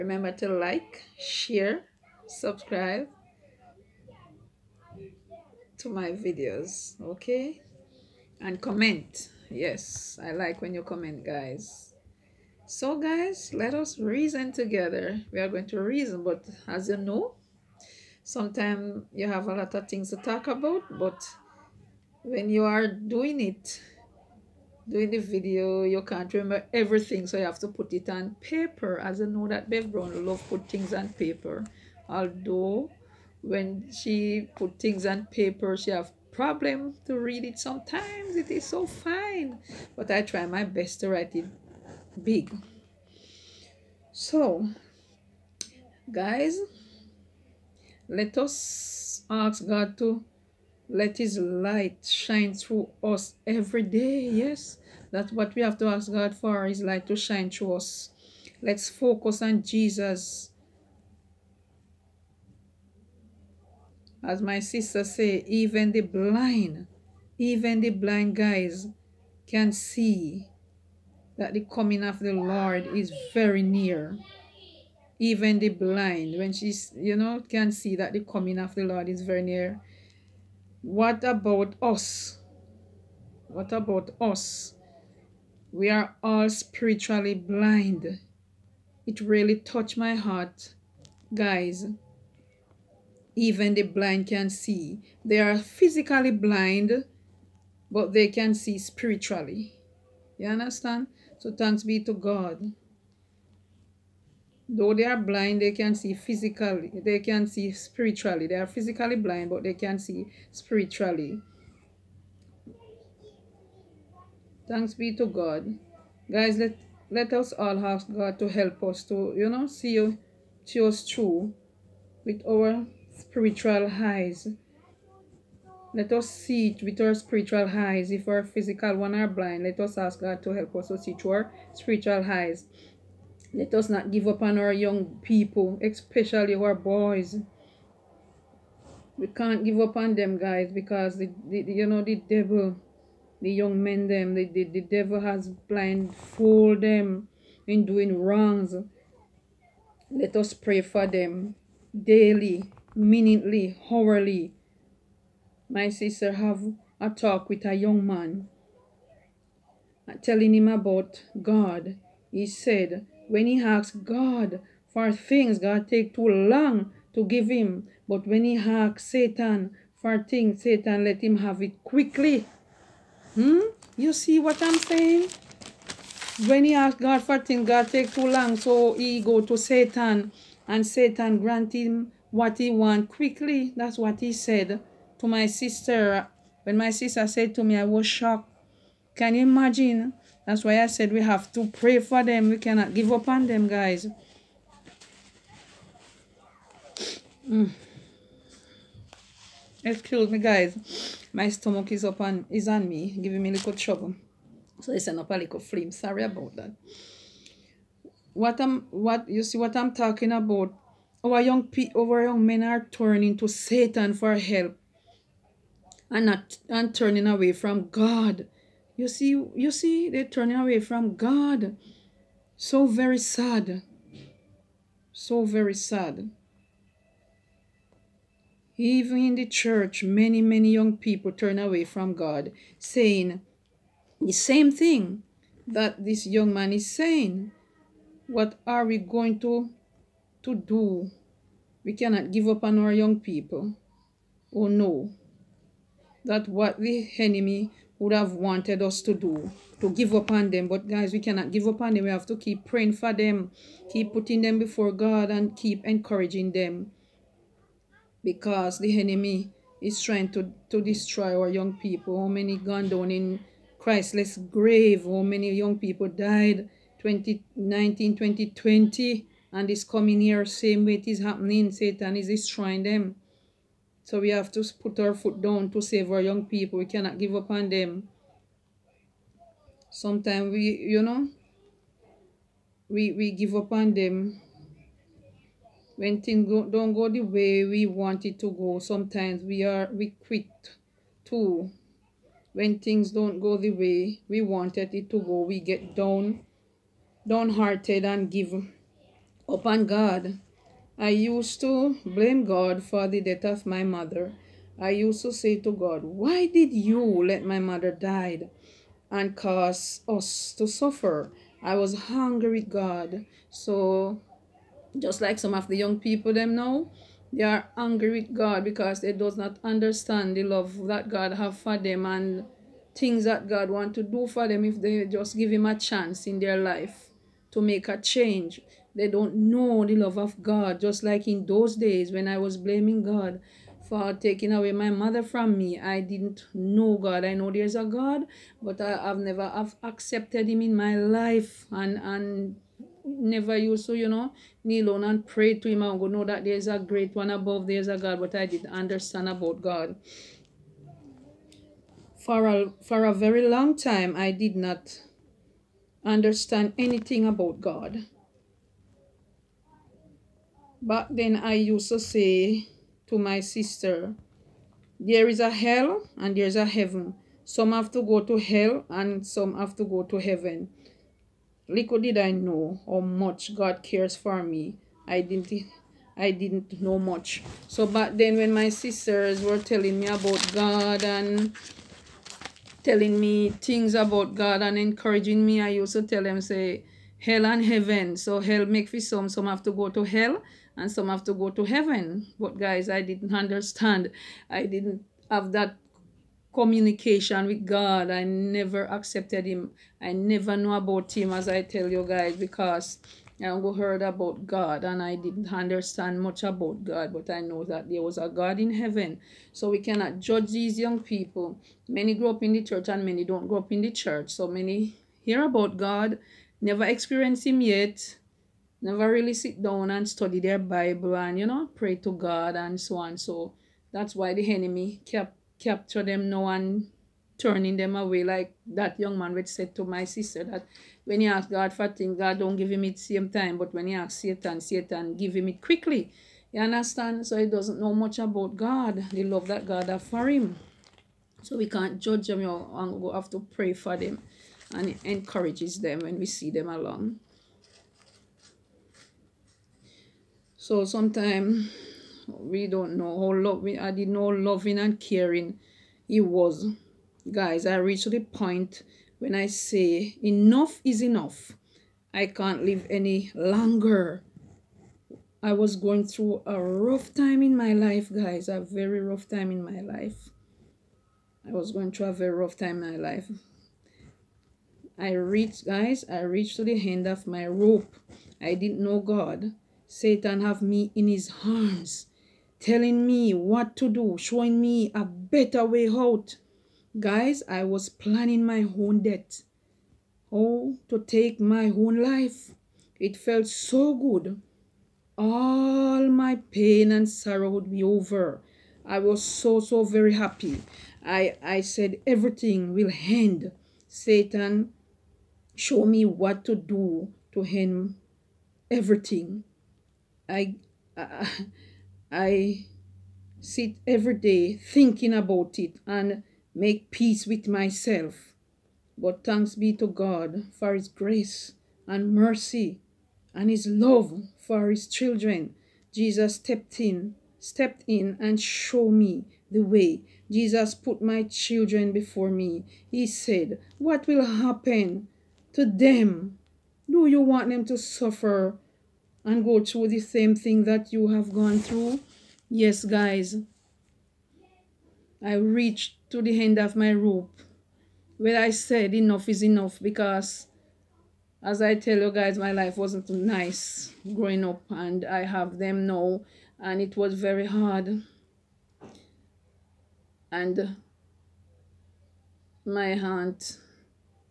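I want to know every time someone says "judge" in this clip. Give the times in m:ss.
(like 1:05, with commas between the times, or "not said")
6:50, 7:21.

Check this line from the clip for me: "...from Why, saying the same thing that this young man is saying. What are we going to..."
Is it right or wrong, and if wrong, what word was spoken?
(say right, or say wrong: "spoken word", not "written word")
wrong: "God", not "Why".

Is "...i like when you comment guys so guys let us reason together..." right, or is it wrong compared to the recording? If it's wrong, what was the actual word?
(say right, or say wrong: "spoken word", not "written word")
right.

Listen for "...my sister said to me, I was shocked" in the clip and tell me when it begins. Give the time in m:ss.
3:06.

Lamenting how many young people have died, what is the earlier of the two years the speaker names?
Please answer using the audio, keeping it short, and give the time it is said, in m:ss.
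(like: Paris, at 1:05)
2019, at 4:27.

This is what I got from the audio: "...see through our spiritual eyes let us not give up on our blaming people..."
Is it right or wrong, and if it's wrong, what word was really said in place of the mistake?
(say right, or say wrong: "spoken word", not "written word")
wrong: "young", not "blaming".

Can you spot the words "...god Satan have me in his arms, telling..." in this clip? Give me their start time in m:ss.
7:58.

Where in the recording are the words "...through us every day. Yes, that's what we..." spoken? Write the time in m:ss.
0:52.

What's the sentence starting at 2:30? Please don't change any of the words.
Let us pray for them daily, minutely, hourly.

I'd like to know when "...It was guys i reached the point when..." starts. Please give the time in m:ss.
7:36.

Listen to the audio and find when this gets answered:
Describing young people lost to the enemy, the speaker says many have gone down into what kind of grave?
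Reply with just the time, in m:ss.
4:23.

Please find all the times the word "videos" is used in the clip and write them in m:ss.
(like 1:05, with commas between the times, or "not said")
0:06, 0:25.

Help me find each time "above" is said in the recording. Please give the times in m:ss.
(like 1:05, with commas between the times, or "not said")
5:47.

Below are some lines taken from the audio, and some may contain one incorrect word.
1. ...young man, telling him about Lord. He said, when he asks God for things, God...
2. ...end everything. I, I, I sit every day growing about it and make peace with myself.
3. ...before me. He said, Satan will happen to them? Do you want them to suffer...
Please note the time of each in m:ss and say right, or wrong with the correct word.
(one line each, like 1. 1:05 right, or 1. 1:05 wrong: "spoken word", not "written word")
1. 2:37 wrong: "God", not "Lord"
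2. 8:27 wrong: "thinking", not "growing"
3. 8:51 wrong: "What", not "Satan".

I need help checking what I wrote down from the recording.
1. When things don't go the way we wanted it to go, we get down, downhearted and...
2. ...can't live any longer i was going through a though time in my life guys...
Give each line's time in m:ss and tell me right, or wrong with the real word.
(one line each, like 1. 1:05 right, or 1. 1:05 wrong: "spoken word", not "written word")
1. 4:52 right
2. 7:42 wrong: "rough", not "though".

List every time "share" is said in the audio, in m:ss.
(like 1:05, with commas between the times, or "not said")
0:01.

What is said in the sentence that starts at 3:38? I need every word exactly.
You see, you see, they're turning away from God.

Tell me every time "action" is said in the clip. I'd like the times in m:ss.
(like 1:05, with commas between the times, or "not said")
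not said.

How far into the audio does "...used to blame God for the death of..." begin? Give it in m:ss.
5:01.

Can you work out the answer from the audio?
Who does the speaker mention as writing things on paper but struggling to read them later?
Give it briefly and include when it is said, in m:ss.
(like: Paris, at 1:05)
Bev Brown, at 0:29.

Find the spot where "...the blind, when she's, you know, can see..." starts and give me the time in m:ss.
1:15.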